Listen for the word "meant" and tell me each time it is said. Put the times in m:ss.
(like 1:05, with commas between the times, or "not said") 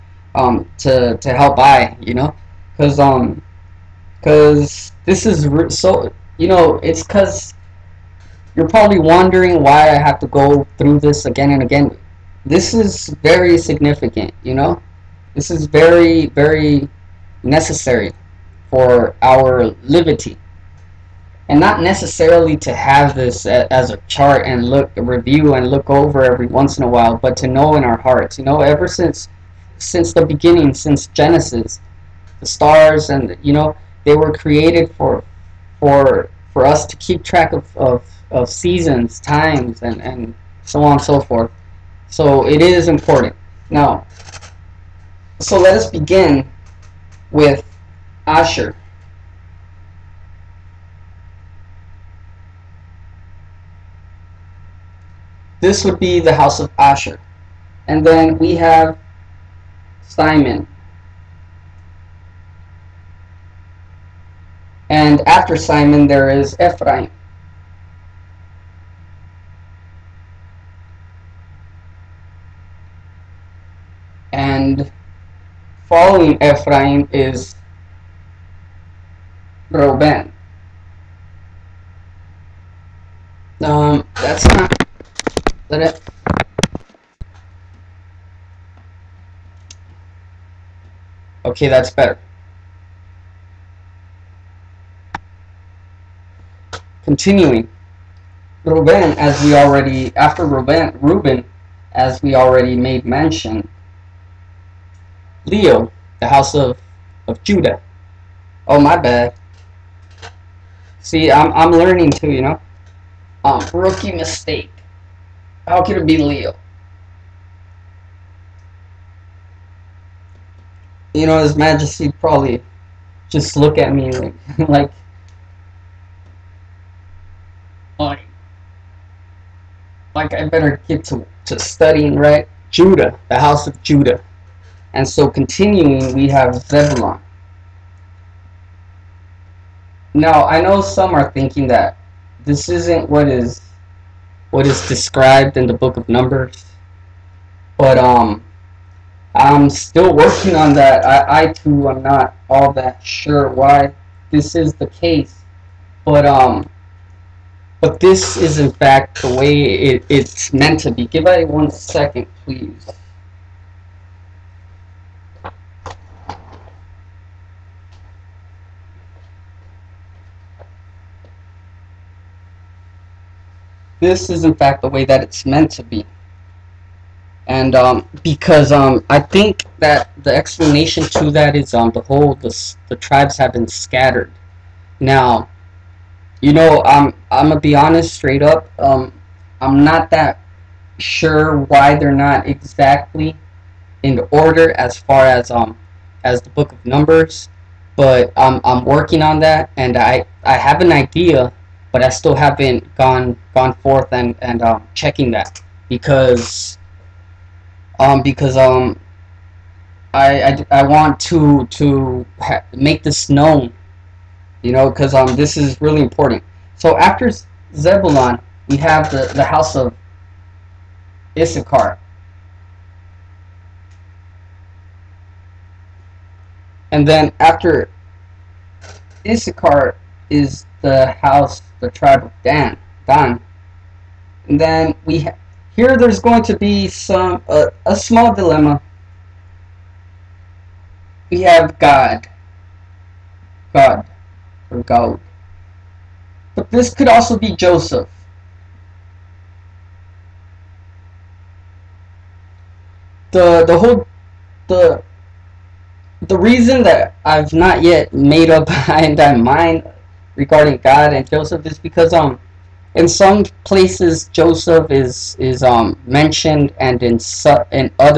2:40, 2:55.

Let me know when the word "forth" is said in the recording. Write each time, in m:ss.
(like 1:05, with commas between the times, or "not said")
0:41, 3:23.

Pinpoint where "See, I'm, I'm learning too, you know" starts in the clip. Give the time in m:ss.
1:50.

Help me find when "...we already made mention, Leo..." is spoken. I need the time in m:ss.
1:42.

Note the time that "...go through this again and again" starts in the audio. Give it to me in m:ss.
0:10.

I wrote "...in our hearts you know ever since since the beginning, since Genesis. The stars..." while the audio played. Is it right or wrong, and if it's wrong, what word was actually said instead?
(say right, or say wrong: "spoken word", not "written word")
right.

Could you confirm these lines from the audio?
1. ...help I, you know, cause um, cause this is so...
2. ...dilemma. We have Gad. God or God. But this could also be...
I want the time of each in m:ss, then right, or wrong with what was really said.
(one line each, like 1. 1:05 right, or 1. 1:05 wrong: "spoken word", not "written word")
1. 0:01 right
2. 3:58 right.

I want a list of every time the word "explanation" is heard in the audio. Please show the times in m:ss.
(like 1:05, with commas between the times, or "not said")
3:00.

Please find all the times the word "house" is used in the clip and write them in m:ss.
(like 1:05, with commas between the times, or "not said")
0:56, 1:46, 2:13, 3:39, 3:51.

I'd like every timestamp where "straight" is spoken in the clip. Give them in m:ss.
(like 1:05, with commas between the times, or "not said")
3:08.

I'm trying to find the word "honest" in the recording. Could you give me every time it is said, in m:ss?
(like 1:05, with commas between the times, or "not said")
3:07.